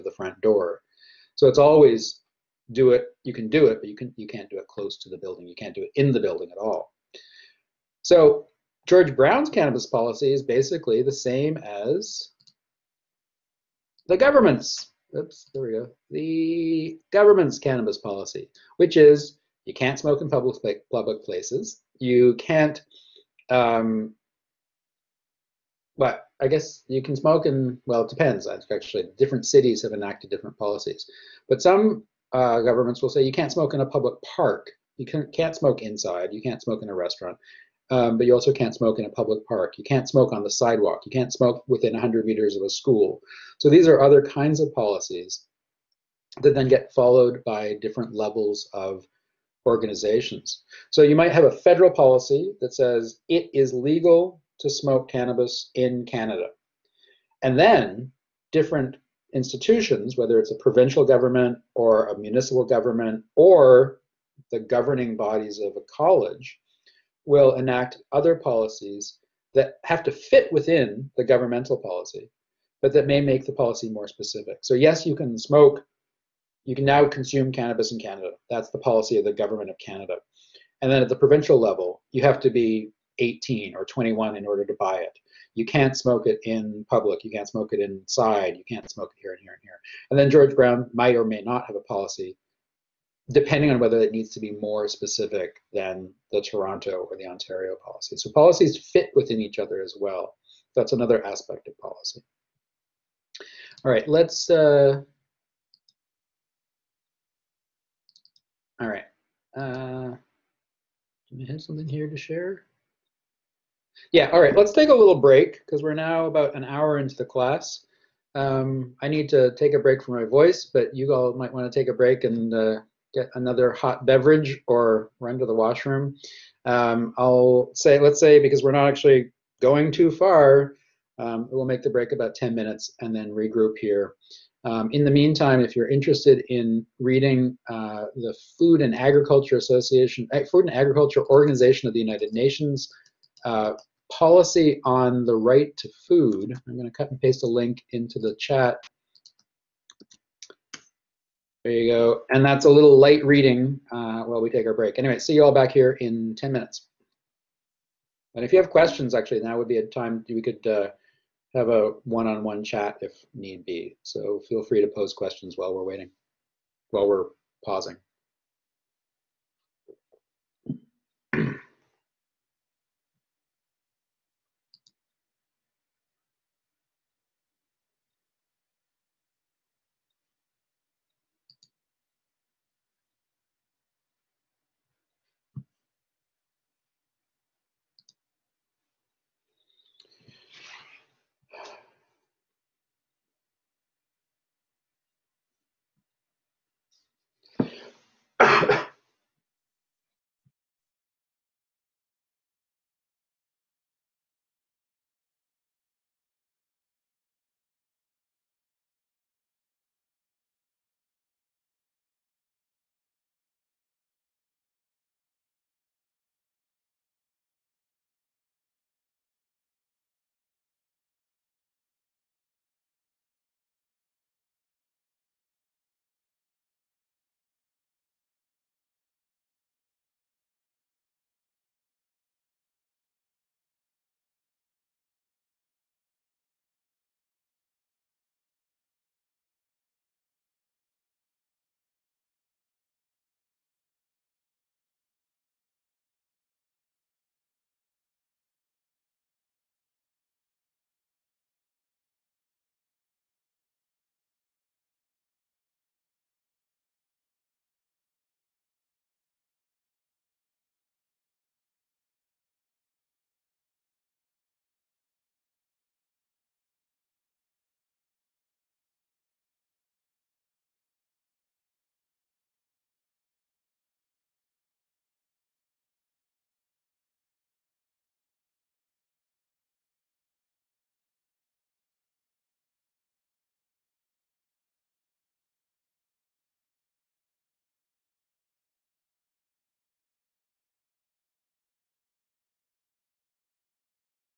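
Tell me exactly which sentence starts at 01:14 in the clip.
So, yes, you can smoke, you can now consume cannabis in Canada.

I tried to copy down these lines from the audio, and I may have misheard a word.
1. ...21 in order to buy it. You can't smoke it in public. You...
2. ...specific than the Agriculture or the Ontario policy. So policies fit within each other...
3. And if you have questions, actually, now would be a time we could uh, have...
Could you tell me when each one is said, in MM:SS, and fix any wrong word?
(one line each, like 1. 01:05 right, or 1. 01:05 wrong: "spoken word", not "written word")
1. 01:23 right
2. 01:34 wrong: "Toronto", not "Agriculture"
3. 02:38 right.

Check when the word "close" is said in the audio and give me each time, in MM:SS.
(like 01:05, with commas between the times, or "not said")
00:04.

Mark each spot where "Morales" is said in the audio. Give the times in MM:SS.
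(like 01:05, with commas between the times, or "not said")
not said.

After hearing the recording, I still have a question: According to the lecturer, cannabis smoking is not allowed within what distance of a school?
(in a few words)
100 meters.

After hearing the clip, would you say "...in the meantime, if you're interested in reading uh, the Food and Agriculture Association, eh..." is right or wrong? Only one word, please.
right.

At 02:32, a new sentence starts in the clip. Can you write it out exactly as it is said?
And that's a little light reading uh, while we take our break.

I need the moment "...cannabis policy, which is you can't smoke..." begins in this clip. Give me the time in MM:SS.
00:17.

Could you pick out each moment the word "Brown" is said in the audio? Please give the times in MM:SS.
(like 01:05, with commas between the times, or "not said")
00:09, 01:30.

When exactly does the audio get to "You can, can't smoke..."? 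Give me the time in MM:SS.
00:34.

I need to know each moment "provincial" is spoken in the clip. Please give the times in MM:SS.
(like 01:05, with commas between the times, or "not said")
01:00, 01:21.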